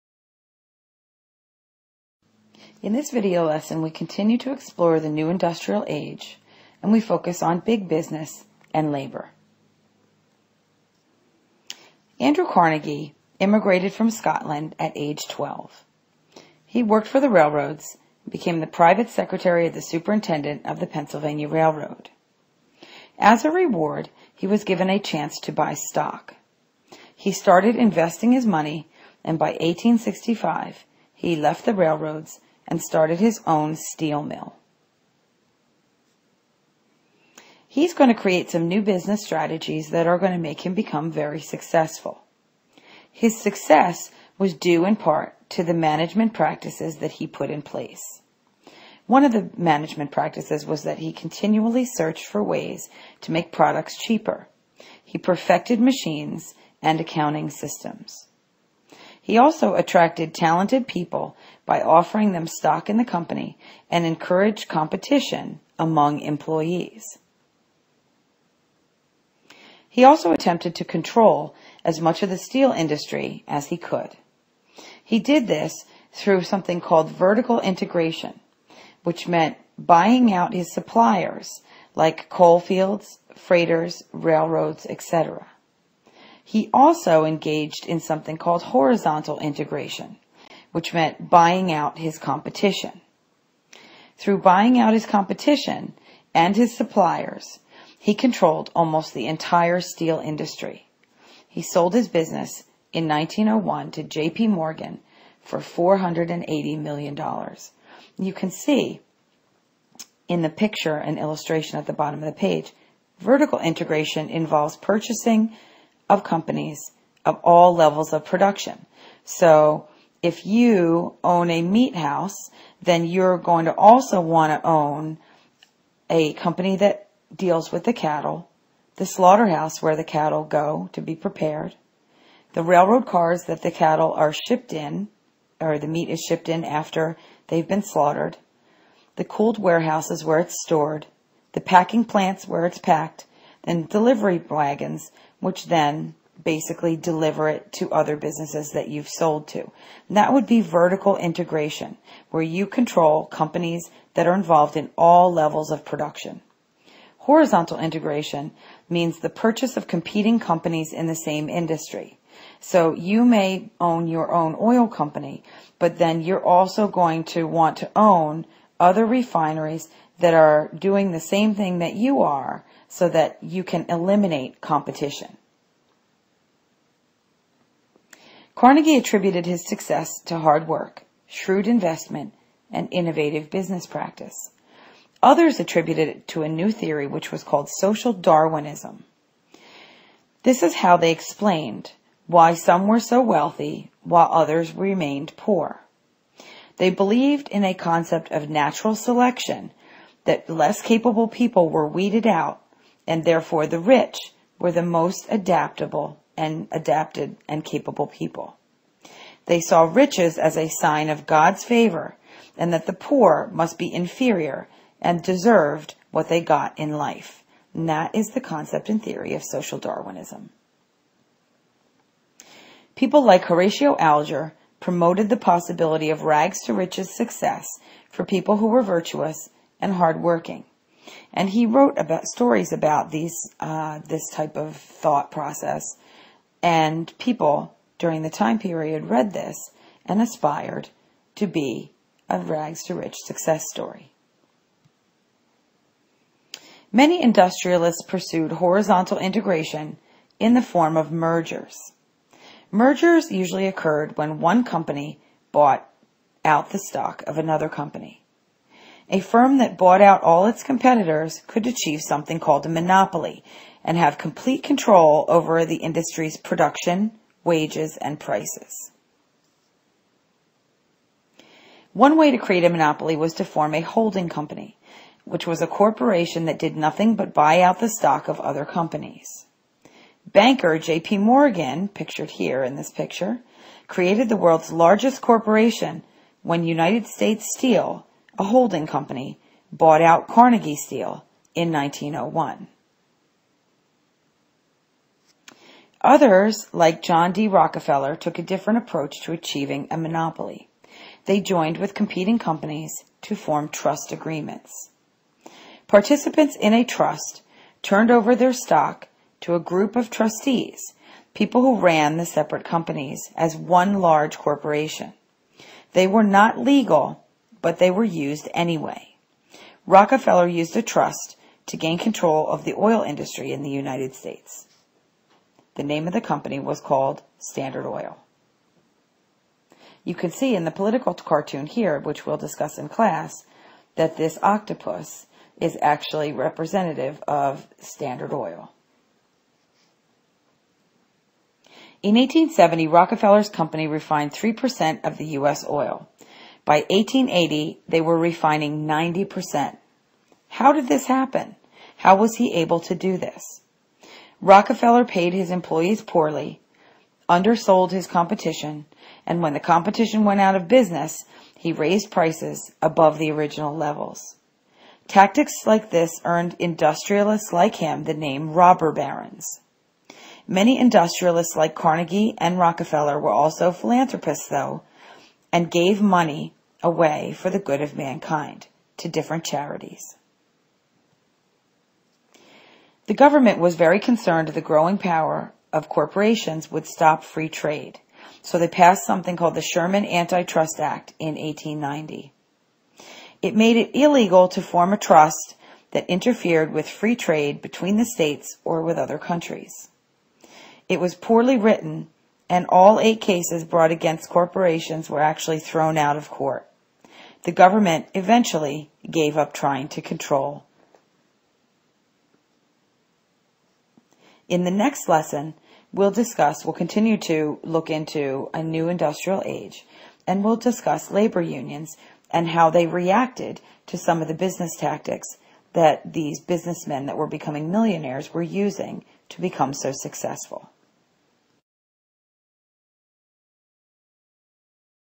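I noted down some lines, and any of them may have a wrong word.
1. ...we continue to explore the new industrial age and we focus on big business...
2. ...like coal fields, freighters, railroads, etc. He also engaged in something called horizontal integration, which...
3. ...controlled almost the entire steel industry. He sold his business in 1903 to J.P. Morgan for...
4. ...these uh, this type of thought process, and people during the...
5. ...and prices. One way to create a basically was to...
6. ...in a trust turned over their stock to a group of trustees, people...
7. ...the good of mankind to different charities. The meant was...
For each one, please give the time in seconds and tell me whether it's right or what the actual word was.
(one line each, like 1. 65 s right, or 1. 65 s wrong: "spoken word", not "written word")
1. 3 s right
2. 81 s right
3. 98 s wrong: "1901", not "1903"
4. 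233 s right
5. 267 s wrong: "monopoly", not "basically"
6. 306 s right
7. 377 s wrong: "government", not "meant".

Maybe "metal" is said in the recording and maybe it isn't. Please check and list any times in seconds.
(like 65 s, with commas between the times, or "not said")
not said.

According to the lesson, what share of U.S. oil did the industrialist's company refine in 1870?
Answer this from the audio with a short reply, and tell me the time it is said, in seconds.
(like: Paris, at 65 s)
3%, at 344 s.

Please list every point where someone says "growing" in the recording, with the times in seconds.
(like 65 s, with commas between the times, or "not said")
384 s.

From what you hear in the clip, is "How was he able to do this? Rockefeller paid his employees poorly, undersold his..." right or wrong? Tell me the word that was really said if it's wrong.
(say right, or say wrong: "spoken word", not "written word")
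right.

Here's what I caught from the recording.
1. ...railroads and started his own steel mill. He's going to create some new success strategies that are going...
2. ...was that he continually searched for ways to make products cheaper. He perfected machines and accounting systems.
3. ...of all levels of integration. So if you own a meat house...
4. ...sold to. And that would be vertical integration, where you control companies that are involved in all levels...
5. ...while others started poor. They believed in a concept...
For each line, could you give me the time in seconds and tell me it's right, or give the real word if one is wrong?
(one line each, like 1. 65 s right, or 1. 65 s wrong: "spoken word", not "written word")
1. 31 s wrong: "business", not "success"
2. 50 s right
3. 117 s wrong: "production", not "integration"
4. 149 s right
5. 194 s wrong: "remained", not "started".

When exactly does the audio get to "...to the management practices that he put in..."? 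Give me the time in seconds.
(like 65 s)
45 s.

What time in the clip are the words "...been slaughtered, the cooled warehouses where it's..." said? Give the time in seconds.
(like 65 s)
137 s.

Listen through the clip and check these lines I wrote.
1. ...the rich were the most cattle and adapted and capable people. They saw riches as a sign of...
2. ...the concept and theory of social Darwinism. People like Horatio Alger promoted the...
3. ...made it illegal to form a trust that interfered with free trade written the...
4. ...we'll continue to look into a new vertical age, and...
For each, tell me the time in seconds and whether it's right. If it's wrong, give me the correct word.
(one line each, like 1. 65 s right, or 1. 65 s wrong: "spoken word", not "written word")
1. 203 s wrong: "adaptable", not "cattle"
2. 218 s right
3. 393 s wrong: "between", not "written"
4. 416 s wrong: "industrial", not "vertical".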